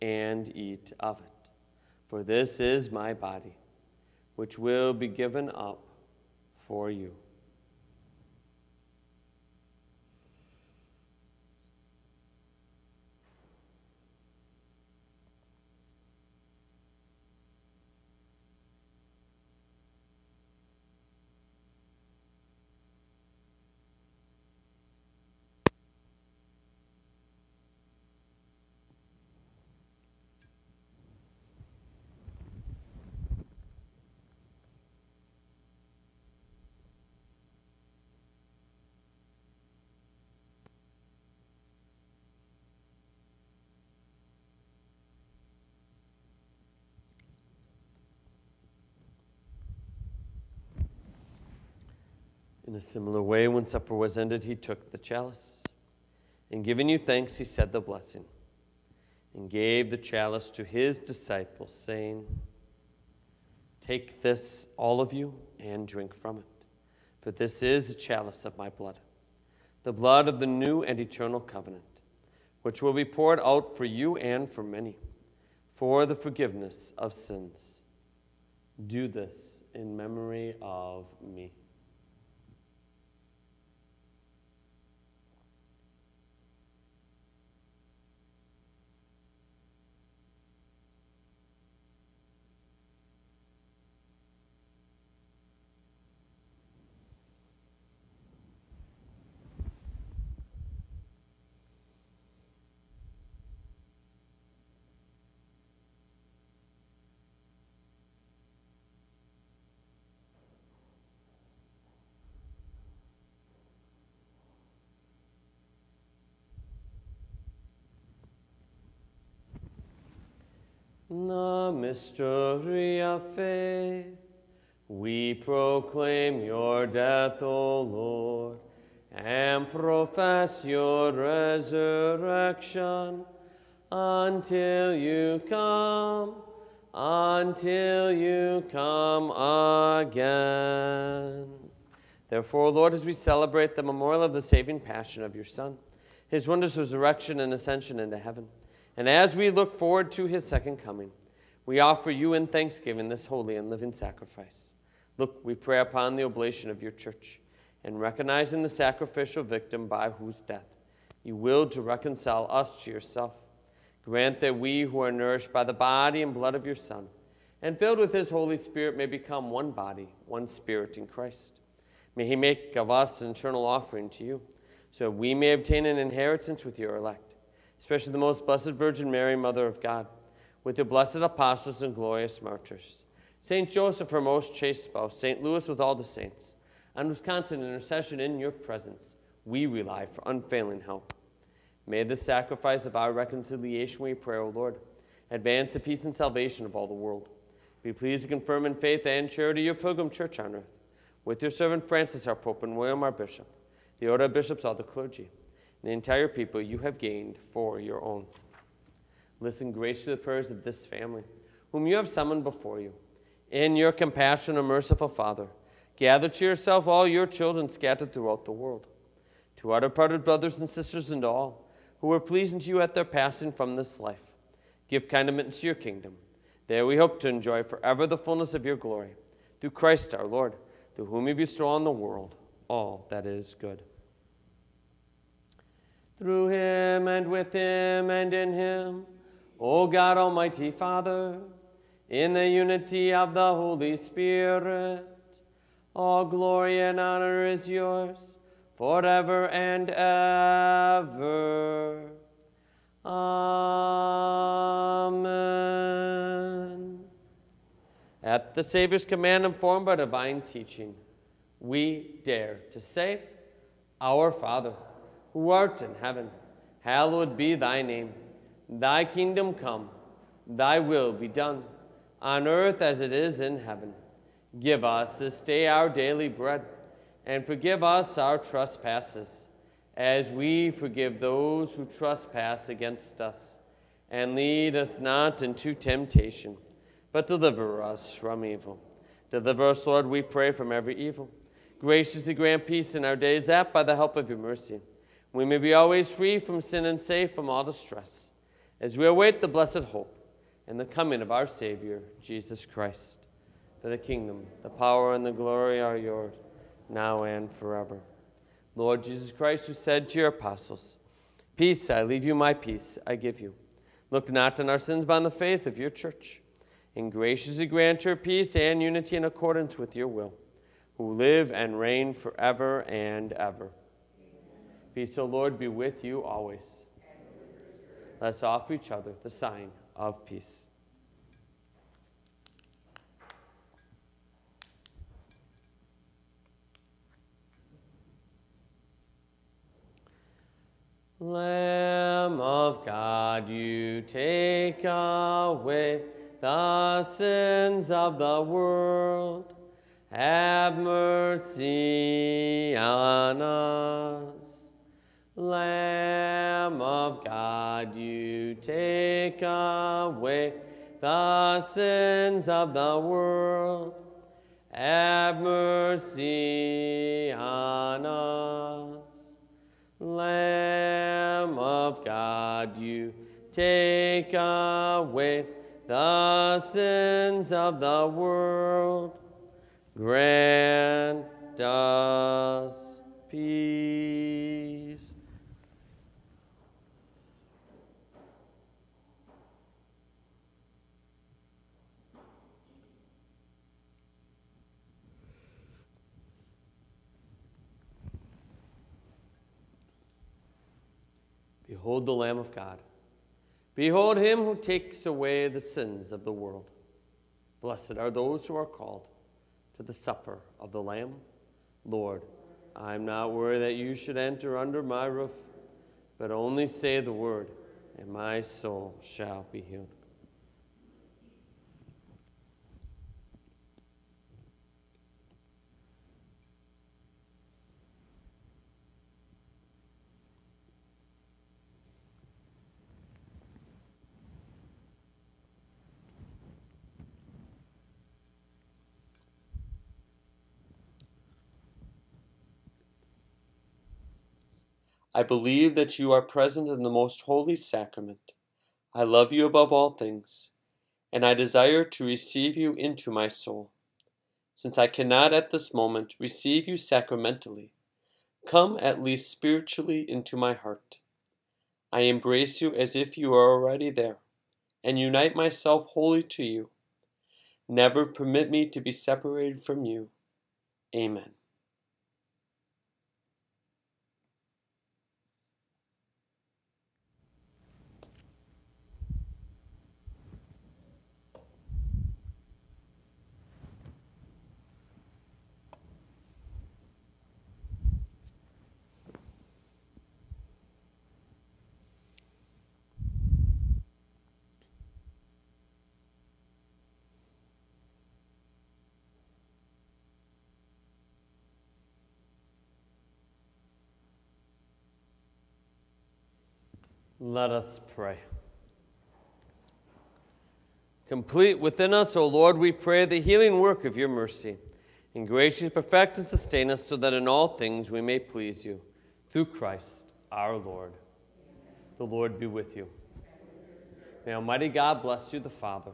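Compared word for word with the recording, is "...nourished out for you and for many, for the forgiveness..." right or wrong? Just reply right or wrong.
wrong.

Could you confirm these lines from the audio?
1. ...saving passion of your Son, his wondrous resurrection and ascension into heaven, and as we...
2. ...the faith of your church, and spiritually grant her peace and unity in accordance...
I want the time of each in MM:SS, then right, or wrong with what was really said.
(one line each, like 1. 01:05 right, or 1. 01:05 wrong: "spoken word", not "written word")
1. 02:24 right
2. 05:15 wrong: "graciously", not "spiritually".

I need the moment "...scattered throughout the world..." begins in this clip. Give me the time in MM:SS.
03:37.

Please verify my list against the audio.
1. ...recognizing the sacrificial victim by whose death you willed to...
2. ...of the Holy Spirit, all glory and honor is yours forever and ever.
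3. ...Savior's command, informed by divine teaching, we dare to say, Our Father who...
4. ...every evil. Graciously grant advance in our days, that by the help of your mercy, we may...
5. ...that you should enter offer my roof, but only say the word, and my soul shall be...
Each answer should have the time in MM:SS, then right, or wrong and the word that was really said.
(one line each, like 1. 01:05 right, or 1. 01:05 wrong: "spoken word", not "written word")
1. 02:37 right
2. 04:03 right
3. 04:18 right
4. 04:50 wrong: "peace", not "advance"
5. 06:53 wrong: "under", not "offer".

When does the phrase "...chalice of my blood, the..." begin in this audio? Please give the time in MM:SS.
01:07.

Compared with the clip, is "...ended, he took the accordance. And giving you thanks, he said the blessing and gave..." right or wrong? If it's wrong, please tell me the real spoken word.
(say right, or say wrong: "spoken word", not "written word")
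wrong: "chalice", not "accordance".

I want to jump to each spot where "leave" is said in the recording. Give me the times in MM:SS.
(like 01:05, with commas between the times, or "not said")
05:12.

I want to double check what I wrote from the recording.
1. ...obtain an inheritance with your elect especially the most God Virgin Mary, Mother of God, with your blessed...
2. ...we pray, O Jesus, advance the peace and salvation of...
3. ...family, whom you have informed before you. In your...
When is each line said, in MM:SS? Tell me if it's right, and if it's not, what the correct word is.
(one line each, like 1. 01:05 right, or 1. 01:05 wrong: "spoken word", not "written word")
1. 02:55 wrong: "Blessed", not "God"
2. 03:14 wrong: "Lord", not "Jesus"
3. 03:30 wrong: "summoned", not "informed".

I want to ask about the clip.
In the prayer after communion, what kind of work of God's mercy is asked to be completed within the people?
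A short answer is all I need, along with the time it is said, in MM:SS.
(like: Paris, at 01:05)
the healing work, at 08:33.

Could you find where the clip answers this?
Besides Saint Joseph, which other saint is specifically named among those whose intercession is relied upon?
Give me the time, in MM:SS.
03:05.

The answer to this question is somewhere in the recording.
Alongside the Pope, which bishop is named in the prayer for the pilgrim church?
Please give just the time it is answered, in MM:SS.
03:22.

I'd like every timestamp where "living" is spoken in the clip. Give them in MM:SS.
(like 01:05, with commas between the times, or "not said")
02:33.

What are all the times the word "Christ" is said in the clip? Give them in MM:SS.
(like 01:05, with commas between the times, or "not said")
02:51, 03:49, 05:02, 05:09, 08:39.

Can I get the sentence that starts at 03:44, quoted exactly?
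Give kind admittance to your kingdom.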